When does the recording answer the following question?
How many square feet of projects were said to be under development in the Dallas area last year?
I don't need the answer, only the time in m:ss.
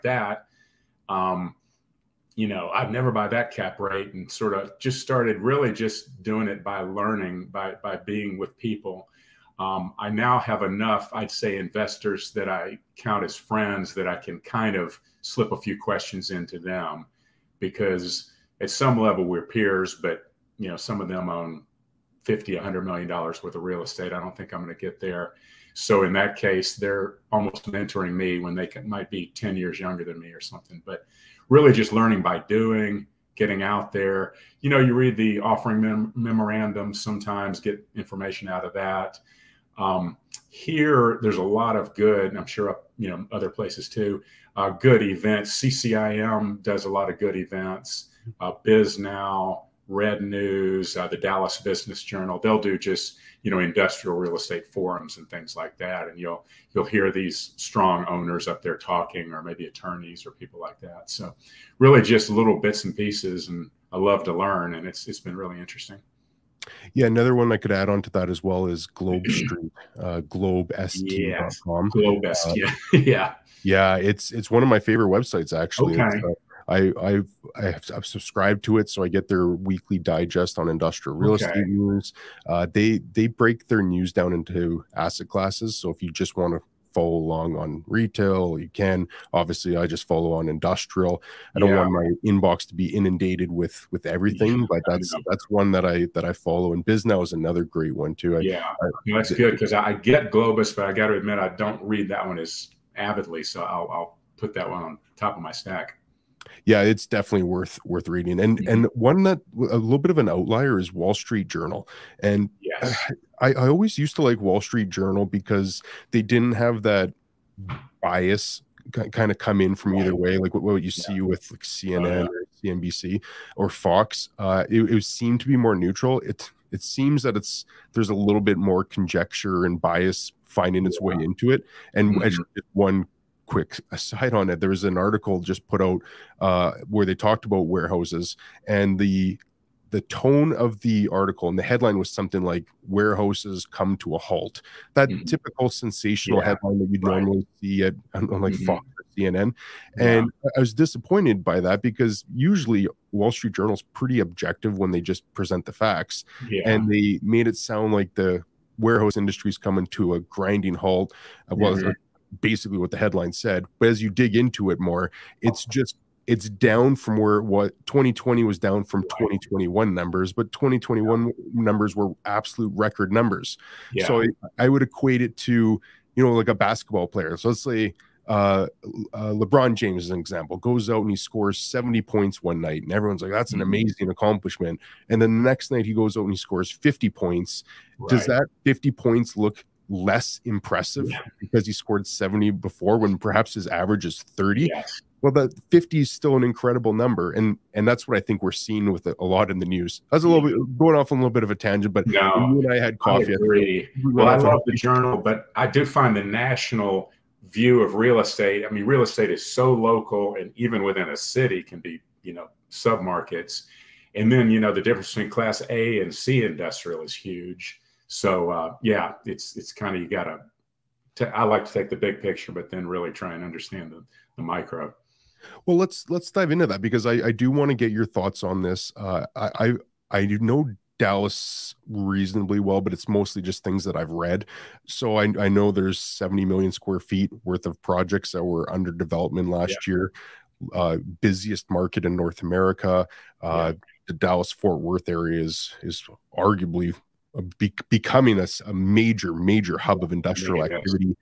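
3:55.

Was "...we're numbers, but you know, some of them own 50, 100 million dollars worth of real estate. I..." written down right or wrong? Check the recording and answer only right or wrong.
wrong.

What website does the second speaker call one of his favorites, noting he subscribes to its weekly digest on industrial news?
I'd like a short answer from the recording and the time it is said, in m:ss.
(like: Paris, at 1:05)
globest.com, at 1:10.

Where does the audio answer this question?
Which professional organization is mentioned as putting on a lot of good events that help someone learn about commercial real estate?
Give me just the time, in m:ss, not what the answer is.
0:45.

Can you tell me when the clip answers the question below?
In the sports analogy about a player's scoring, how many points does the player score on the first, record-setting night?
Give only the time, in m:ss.
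3:01.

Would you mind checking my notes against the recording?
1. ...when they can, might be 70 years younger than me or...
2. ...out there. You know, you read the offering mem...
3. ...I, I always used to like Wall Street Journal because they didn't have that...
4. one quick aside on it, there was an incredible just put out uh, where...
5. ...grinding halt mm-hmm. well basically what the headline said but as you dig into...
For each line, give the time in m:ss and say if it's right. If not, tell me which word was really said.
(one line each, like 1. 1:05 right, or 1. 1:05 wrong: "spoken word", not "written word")
1. 0:28 wrong: "10", not "70"
2. 0:33 right
3. 1:53 right
4. 2:12 wrong: "article", not "incredible"
5. 2:40 right.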